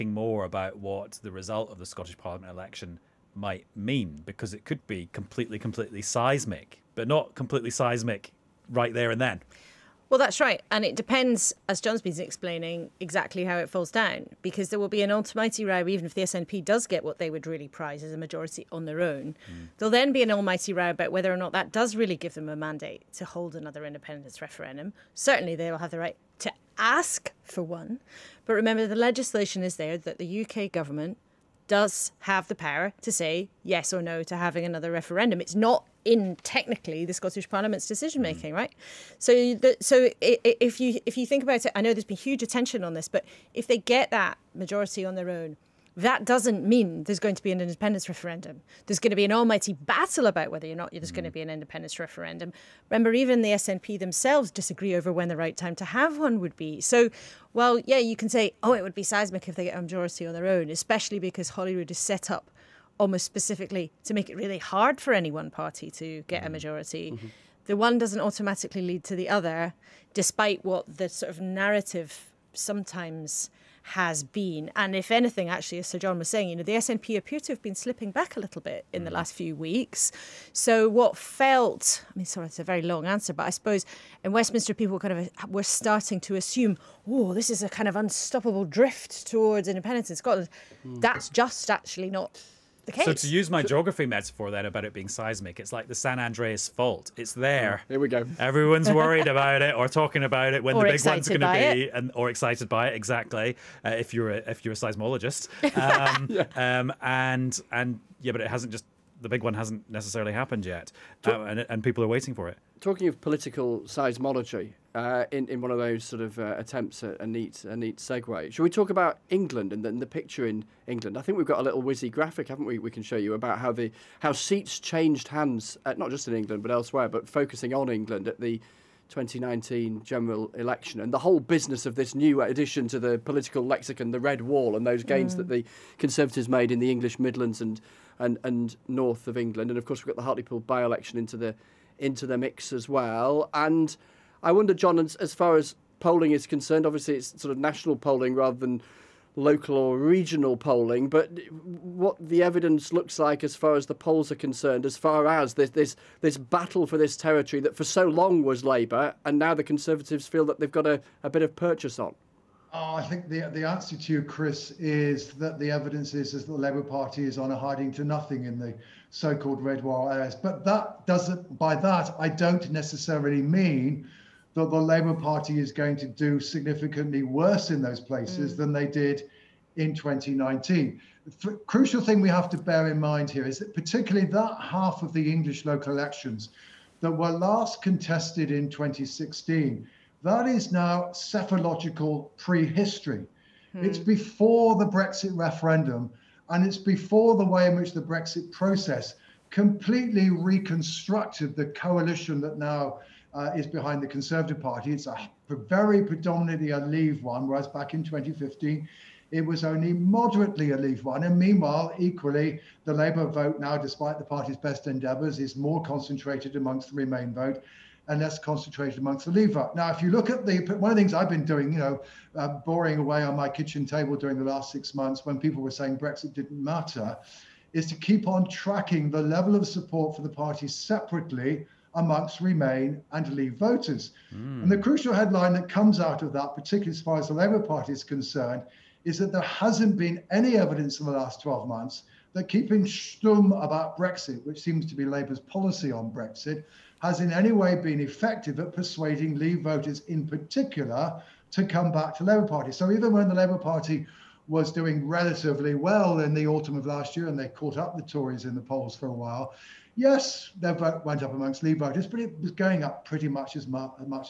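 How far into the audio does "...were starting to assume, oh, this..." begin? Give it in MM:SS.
01:25.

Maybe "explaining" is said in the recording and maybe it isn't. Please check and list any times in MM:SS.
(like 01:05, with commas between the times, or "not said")
00:12.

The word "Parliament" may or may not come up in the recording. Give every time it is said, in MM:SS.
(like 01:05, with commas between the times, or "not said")
00:02, 00:37.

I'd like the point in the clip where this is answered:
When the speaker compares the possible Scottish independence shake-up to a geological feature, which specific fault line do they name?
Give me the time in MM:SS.
01:35.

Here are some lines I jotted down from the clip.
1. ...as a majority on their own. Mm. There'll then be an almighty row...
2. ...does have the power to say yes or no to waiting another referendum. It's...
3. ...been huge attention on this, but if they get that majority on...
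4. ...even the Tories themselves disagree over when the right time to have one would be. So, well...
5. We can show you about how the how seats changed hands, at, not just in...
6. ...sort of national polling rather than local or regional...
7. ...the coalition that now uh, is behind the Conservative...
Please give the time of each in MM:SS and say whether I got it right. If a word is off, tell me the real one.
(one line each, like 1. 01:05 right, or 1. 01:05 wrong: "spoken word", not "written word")
1. 00:18 right
2. 00:31 wrong: "having", not "waiting"
3. 00:42 right
4. 00:53 wrong: "SNP", not "Tories"
5. 02:02 right
6. 02:27 right
7. 03:21 right.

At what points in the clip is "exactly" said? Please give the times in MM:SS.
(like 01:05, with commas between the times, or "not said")
00:12, 01:42.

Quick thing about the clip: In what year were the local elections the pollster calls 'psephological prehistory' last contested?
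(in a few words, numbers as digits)
2016.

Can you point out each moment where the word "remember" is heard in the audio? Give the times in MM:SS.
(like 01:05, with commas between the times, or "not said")
00:28, 00:52.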